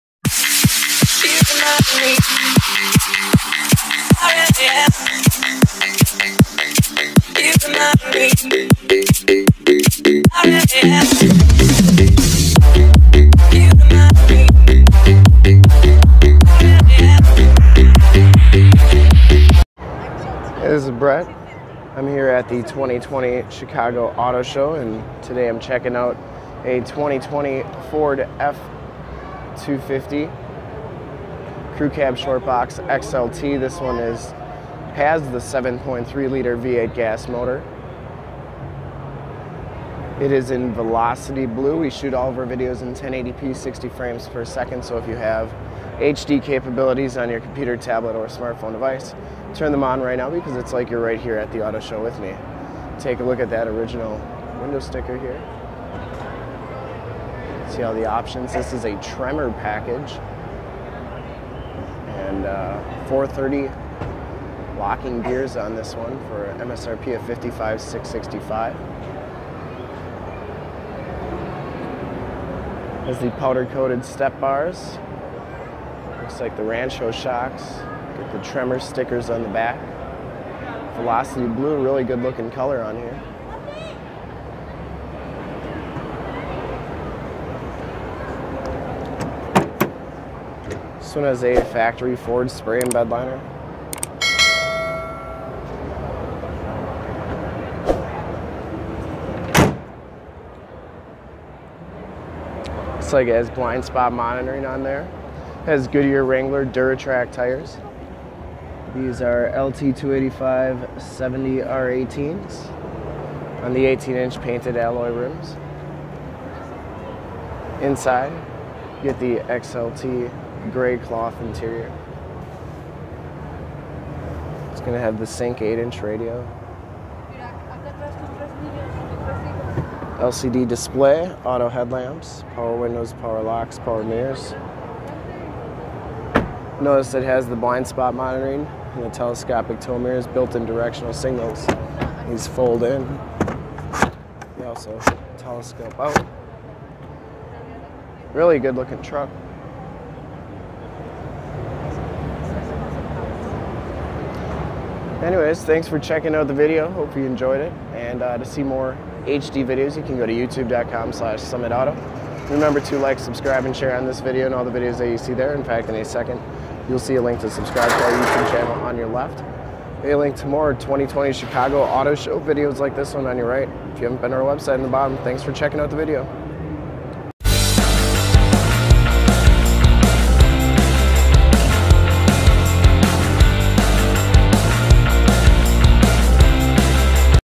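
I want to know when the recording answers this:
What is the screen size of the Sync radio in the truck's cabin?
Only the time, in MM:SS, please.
02:05.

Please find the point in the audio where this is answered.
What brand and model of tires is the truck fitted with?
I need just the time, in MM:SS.
01:45.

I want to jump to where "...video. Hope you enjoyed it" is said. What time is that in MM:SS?
02:36.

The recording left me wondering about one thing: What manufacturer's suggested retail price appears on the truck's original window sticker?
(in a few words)
$55,665.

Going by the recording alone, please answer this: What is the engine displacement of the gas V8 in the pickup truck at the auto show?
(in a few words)
7.3 liter.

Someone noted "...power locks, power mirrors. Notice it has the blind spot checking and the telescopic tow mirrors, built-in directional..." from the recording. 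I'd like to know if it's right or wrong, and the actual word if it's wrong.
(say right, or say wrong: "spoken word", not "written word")
wrong: "monitoring", not "checking".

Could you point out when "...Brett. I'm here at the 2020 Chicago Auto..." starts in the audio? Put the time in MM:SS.
00:20.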